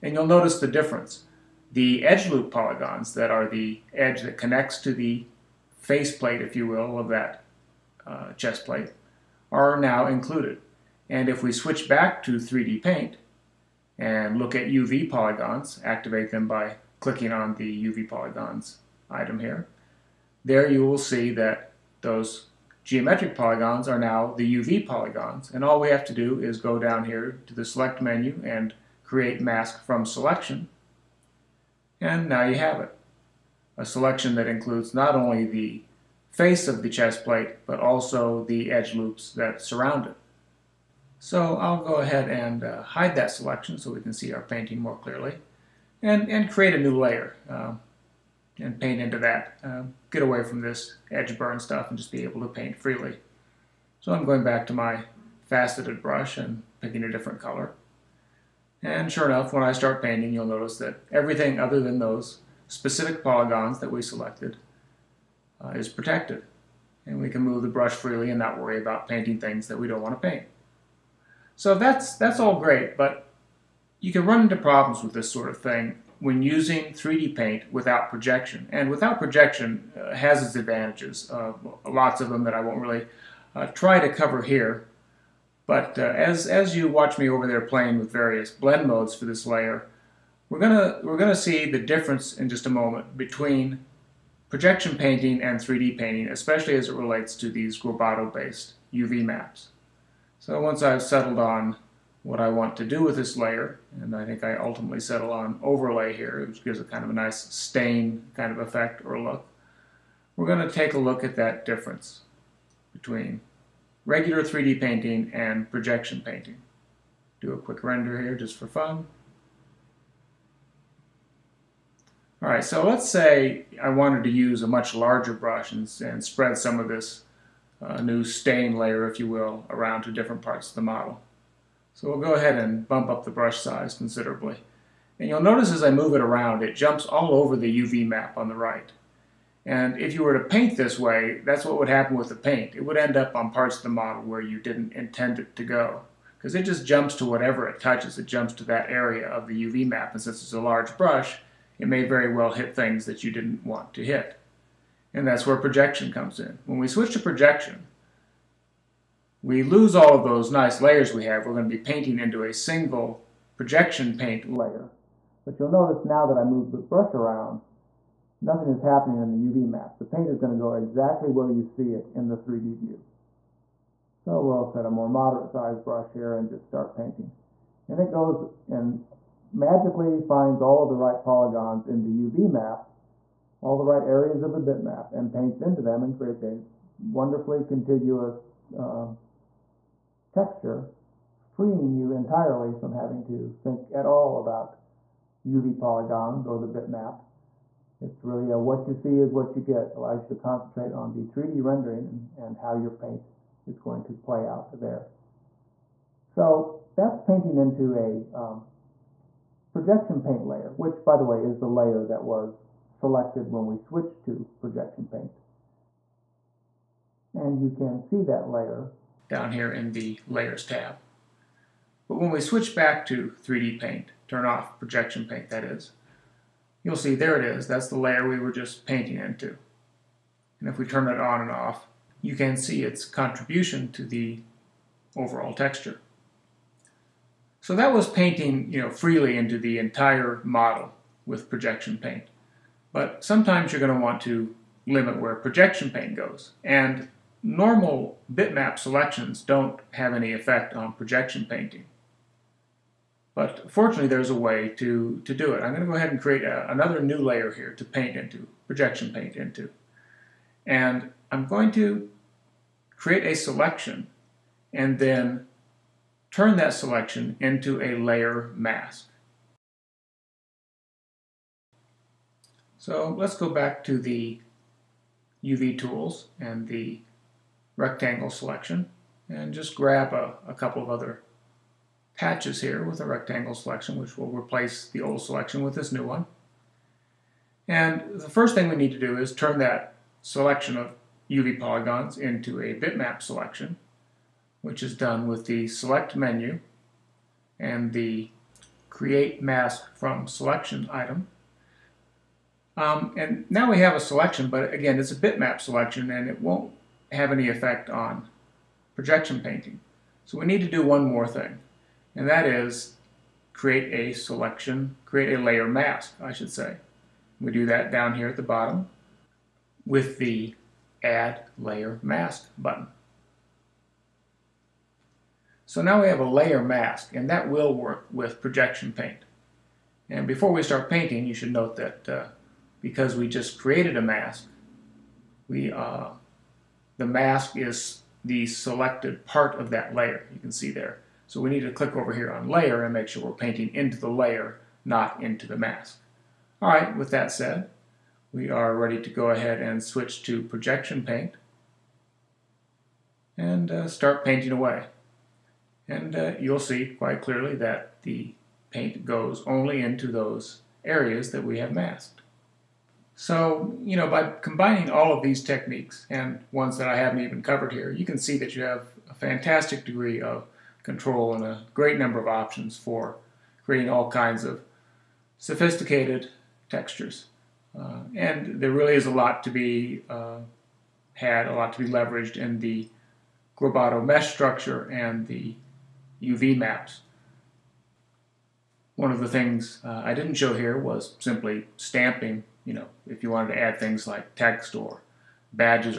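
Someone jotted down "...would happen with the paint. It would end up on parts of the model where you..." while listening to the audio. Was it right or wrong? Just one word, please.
right.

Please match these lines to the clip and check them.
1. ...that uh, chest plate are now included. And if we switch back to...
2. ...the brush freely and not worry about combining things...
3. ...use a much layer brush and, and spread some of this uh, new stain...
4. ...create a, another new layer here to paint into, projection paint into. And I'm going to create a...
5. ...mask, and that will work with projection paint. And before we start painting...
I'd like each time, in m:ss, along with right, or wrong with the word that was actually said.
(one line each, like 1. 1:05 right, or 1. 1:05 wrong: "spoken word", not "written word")
1. 0:07 right
2. 1:07 wrong: "painting", not "combining"
3. 2:04 wrong: "larger", not "layer"
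4. 4:16 right
5. 5:26 right.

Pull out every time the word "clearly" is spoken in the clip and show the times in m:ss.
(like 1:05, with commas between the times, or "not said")
0:45, 5:57.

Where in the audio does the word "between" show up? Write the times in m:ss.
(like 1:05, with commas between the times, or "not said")
1:33, 1:52.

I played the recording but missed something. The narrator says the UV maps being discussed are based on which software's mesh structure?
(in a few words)
GroBoto.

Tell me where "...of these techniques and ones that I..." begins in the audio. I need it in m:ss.
6:05.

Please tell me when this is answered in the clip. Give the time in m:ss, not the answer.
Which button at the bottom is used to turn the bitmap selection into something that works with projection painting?
5:21.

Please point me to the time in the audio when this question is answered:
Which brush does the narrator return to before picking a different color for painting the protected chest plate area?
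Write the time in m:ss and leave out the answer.
0:55.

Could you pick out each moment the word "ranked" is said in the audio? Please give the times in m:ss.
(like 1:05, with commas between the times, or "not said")
not said.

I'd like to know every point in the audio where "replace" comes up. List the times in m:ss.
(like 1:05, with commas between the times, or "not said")
4:44.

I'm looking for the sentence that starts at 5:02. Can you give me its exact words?
Um, and now we have a selection, but again, it's a bitmap selection and it won't have any effect on projection painting.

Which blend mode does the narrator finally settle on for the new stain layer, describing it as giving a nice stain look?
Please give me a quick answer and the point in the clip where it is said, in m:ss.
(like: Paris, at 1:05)
overlay, at 1:45.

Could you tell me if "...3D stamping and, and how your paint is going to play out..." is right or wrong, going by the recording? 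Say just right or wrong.
wrong.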